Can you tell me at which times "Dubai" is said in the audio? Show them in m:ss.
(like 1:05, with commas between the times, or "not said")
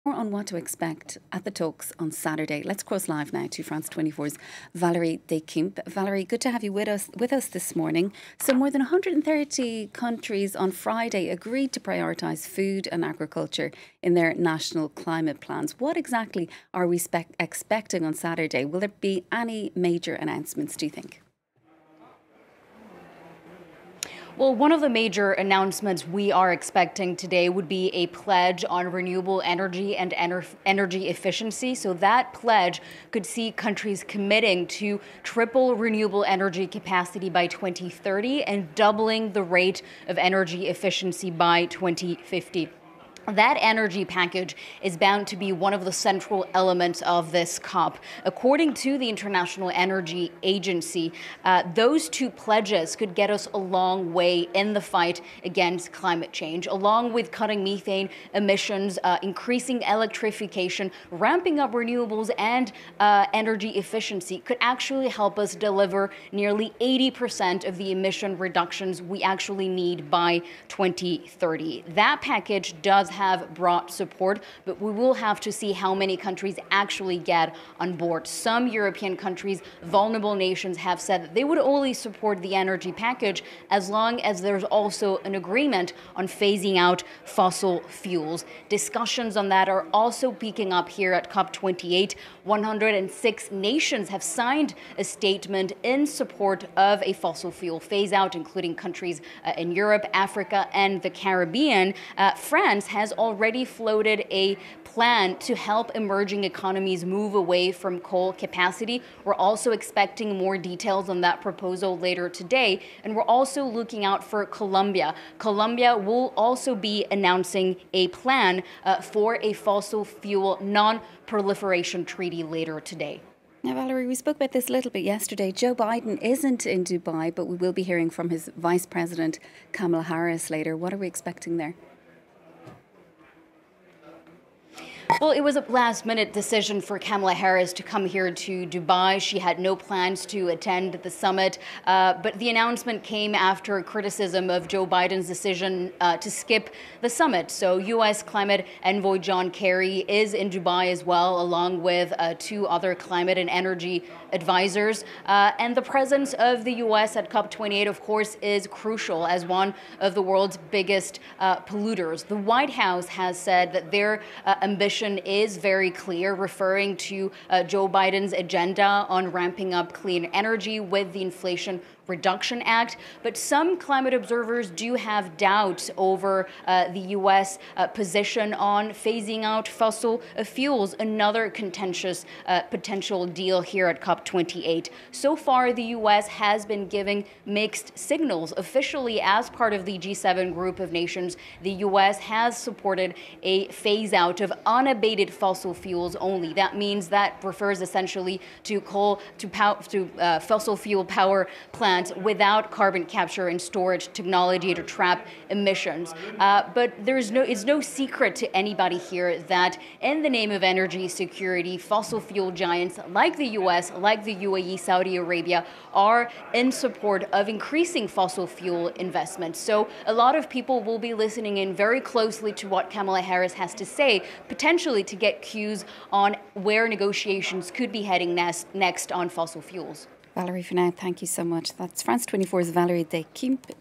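2:06, 2:18, 2:30.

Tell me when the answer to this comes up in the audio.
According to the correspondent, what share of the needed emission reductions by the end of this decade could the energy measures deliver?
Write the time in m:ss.
1:06.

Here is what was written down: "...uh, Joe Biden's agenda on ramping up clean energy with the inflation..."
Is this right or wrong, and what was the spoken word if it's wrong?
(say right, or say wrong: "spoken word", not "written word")
right.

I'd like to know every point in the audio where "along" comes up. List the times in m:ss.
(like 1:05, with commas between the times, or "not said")
0:56, 2:31.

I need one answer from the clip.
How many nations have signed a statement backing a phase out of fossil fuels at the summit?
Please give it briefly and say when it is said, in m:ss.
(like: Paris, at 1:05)
106, at 1:32.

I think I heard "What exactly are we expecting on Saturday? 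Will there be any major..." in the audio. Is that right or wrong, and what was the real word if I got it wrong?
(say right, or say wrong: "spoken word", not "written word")
right.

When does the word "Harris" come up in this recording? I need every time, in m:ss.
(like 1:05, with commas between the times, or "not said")
2:10, 2:17, 3:43.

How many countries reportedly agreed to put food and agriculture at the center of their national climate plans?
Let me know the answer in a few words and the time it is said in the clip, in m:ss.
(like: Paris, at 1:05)
more than 130, at 0:08.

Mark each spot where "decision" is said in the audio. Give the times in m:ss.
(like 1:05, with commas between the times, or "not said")
2:16, 2:25.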